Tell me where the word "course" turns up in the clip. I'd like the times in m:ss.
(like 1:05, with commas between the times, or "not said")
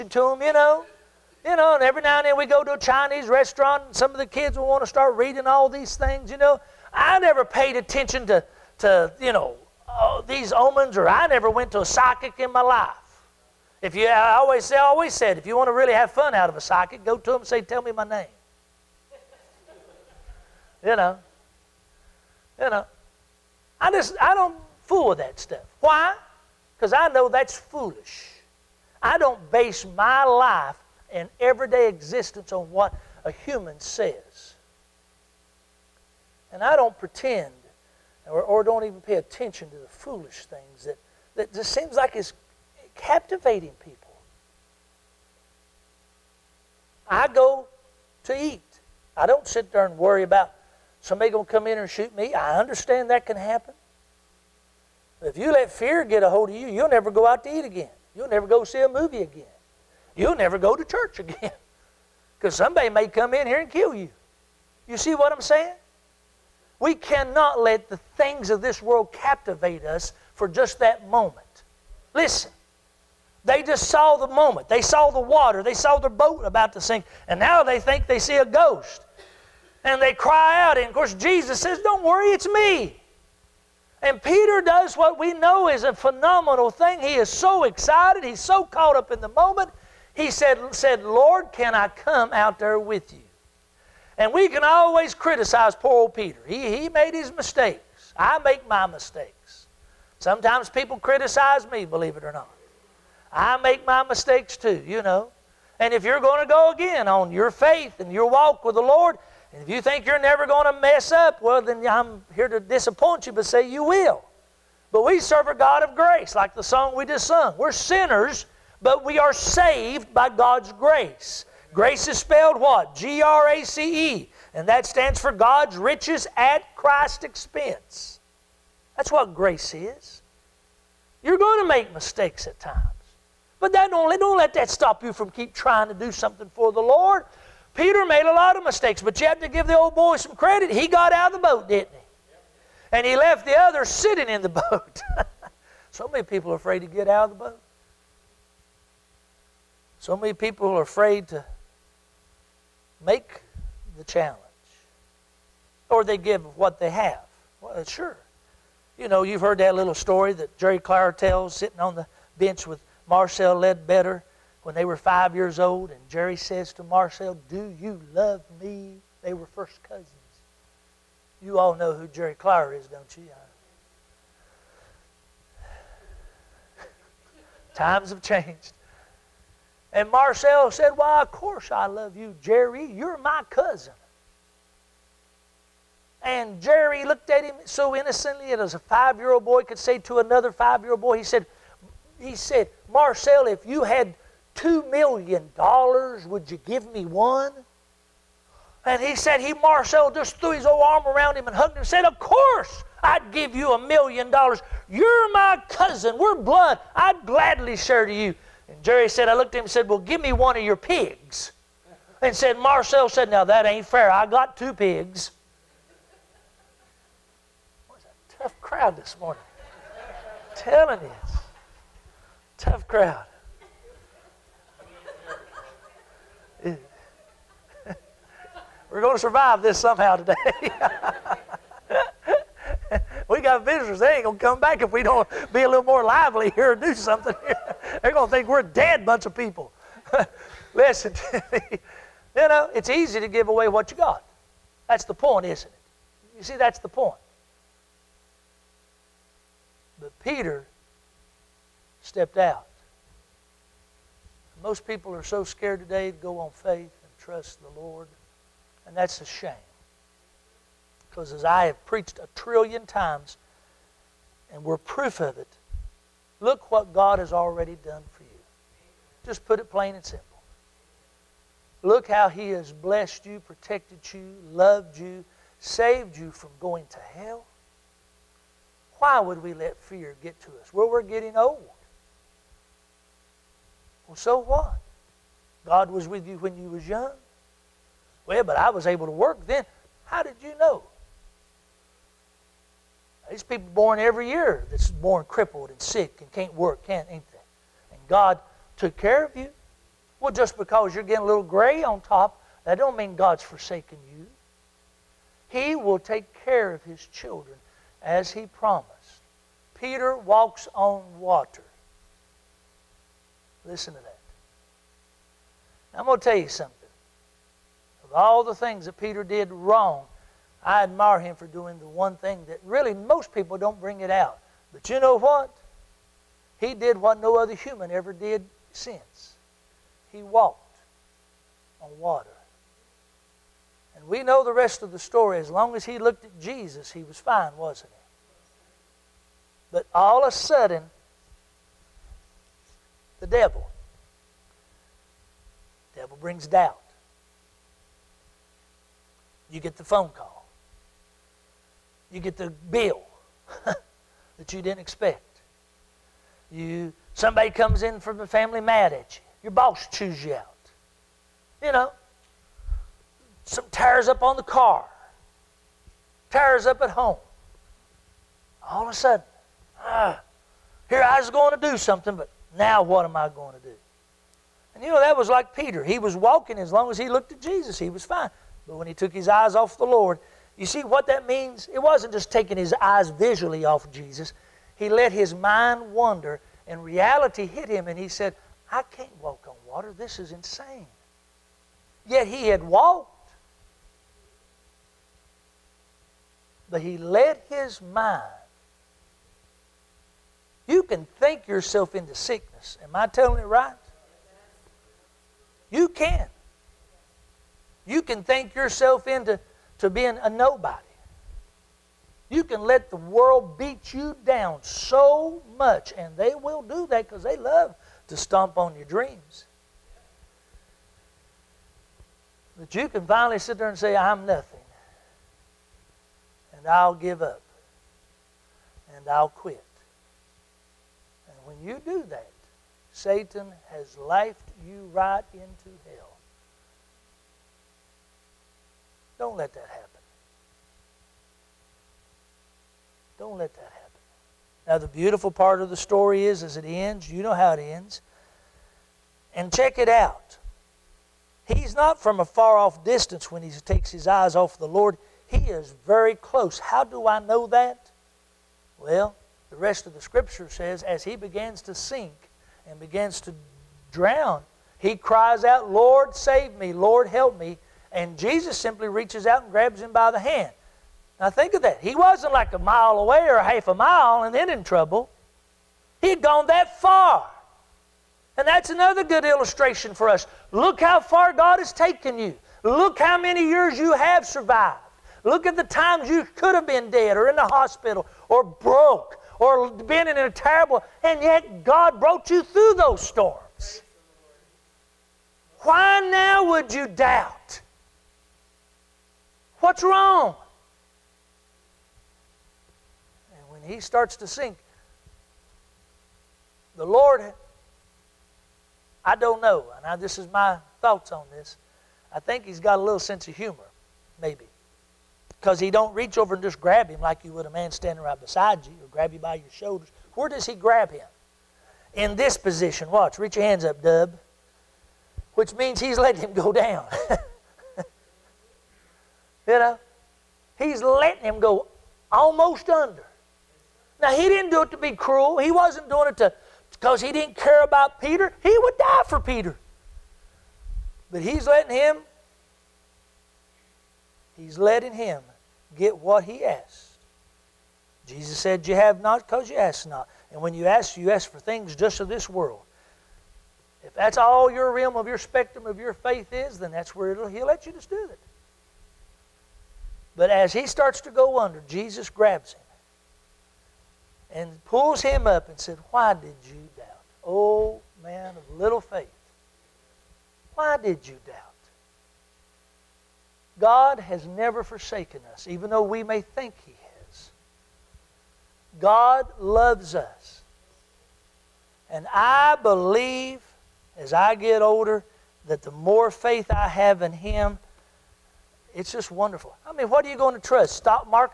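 1:20, 3:01, 3:22.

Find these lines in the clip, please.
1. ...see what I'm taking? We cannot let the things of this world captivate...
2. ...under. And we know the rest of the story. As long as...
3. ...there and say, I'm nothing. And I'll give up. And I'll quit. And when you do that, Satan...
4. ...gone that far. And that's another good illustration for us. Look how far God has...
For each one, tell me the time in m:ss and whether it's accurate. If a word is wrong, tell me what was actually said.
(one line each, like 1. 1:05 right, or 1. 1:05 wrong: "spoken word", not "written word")
1. 1:04 wrong: "saying", not "taking"
2. 5:31 wrong: "water", not "under"
3. 7:03 right
4. 7:56 right.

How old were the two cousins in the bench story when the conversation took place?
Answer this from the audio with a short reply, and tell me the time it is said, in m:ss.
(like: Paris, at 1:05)
5, at 2:44.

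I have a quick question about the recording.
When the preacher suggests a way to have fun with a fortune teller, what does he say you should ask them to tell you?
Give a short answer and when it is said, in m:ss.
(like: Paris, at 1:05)
My name, at 0:17.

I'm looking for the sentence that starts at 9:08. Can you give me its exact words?
Jesus said, You have not because you ask not.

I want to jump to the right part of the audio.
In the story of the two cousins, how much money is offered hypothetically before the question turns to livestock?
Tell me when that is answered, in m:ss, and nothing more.
3:14.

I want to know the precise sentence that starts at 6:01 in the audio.
You know, some tires up on the car, tires up at home.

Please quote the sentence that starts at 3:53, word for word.
They ain't going to come back if we don't be a little more lively here and do something here.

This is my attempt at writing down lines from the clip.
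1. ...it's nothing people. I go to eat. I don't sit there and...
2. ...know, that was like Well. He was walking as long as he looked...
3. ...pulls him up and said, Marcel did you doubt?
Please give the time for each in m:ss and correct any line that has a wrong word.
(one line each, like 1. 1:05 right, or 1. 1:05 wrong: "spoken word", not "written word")
1. 0:42 wrong: "captivating", not "nothing"
2. 6:14 wrong: "Peter", not "Well"
3. 9:24 wrong: "Why", not "Marcel".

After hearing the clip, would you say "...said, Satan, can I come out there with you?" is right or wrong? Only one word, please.
wrong.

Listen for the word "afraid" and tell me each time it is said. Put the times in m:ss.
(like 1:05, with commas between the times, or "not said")
2:26, 2:30.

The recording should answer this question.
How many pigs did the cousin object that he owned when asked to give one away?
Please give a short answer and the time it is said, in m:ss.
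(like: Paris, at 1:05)
2, at 3:34.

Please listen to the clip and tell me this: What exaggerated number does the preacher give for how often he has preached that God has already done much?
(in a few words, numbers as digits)
A trillion.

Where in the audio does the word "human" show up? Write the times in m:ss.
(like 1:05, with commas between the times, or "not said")
0:33, 5:27.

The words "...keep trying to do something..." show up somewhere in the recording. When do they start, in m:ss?
2:15.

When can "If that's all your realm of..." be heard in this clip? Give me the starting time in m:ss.
9:13.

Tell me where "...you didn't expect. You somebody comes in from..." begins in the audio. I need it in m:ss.
5:54.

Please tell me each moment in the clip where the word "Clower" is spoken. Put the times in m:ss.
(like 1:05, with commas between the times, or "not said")
2:40, 2:52.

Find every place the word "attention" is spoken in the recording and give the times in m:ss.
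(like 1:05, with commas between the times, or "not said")
0:07, 0:39.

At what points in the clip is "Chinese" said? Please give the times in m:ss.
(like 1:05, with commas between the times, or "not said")
0:02.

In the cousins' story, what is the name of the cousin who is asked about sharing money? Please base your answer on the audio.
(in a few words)
Marcel Ledbetter.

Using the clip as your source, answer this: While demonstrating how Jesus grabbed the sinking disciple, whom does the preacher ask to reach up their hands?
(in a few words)
Dub.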